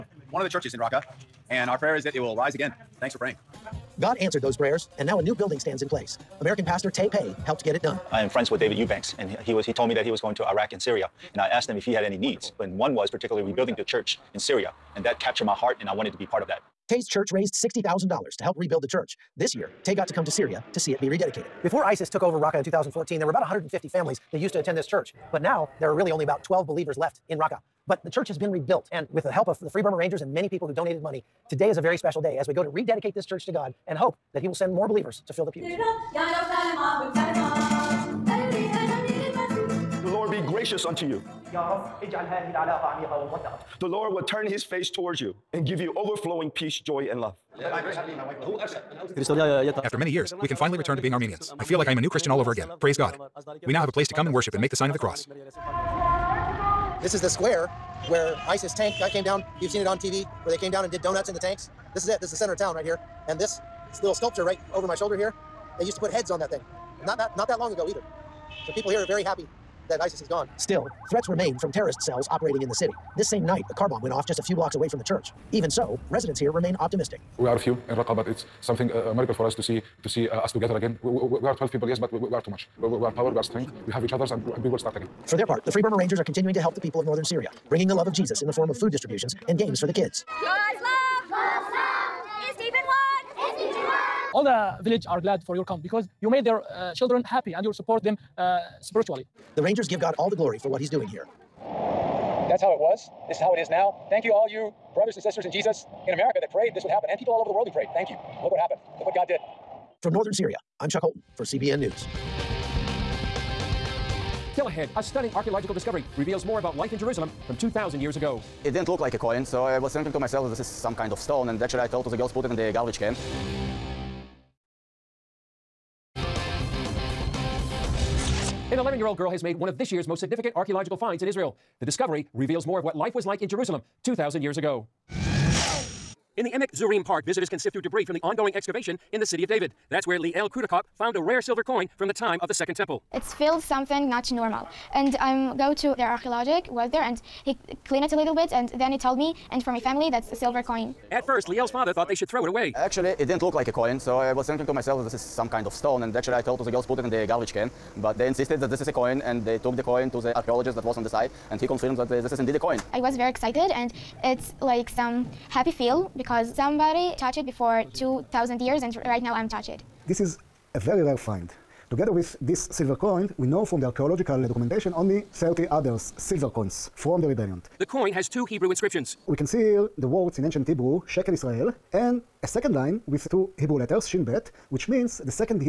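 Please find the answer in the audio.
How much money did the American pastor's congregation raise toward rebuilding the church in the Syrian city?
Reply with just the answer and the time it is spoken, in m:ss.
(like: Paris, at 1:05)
$60,000, at 0:17.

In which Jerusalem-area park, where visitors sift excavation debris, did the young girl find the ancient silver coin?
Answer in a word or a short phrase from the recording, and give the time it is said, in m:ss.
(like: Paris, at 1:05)
Emek Zurim Park, at 2:16.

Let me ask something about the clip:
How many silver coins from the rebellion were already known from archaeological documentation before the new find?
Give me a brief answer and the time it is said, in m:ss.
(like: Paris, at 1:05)
30, at 2:55.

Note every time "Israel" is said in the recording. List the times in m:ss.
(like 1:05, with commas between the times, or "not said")
2:11, 3:01.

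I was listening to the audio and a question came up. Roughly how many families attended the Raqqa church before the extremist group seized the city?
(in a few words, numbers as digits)
150.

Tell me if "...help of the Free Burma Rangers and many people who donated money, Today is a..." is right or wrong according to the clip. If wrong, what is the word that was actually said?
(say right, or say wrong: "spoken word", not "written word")
right.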